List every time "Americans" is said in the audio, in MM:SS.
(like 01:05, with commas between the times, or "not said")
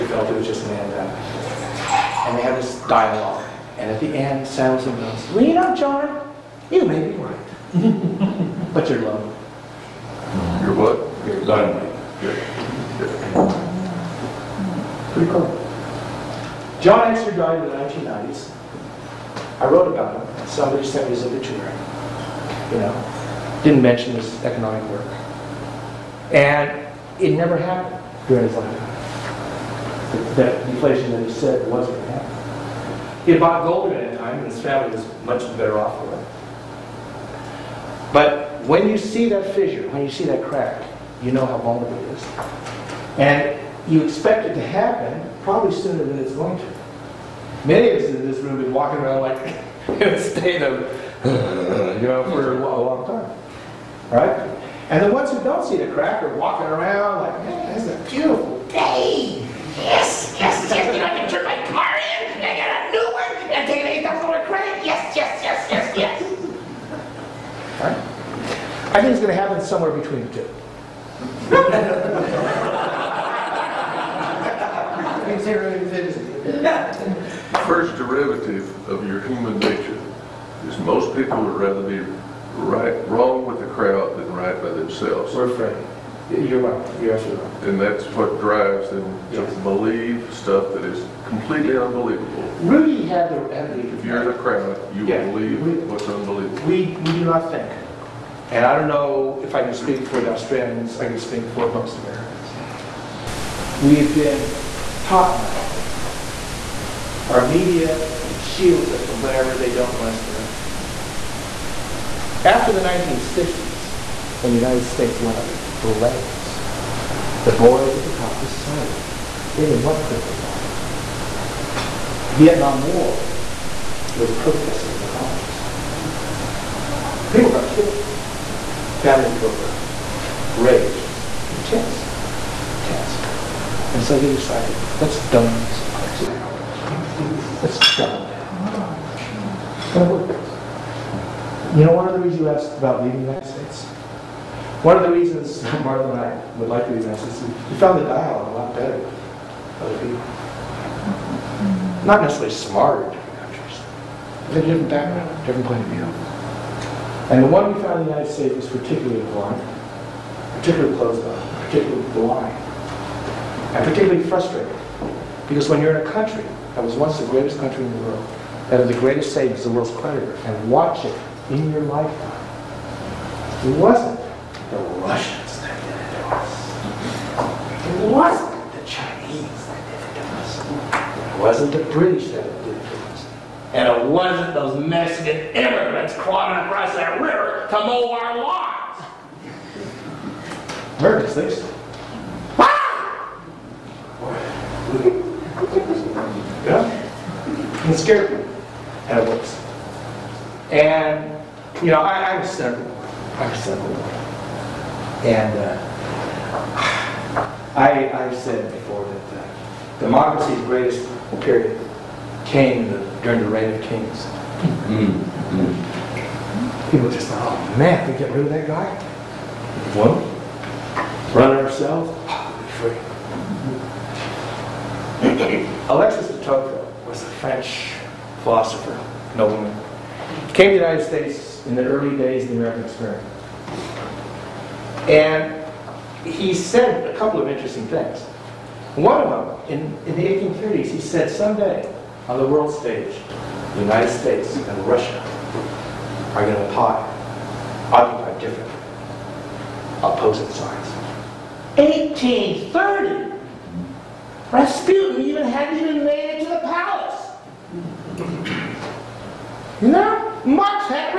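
01:41, 03:10, 03:52.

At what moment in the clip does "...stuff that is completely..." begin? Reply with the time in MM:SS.
01:30.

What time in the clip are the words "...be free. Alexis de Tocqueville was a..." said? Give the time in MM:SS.
03:42.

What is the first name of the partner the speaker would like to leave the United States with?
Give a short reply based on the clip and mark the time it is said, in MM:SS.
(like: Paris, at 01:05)
Martha, at 02:25.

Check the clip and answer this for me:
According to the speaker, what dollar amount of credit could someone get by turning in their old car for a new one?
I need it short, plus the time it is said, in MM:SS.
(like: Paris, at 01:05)
$8,000, at 01:04.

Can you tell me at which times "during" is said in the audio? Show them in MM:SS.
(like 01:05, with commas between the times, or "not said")
00:28, 03:33.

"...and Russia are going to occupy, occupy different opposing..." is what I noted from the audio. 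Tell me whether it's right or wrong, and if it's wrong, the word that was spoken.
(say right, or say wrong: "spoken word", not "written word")
right.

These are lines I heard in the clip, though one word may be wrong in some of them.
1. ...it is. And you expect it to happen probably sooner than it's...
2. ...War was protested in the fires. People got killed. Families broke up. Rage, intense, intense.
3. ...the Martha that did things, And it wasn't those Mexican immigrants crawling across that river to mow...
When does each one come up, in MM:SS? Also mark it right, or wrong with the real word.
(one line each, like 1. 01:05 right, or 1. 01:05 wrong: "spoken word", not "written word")
1. 00:42 right
2. 02:02 wrong: "colleges", not "fires"
3. 03:01 wrong: "British", not "Martha".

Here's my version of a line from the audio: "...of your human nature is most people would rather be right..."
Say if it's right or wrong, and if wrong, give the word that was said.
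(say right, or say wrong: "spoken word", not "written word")
right.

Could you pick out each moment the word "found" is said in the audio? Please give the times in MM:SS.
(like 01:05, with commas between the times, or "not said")
02:27, 02:37.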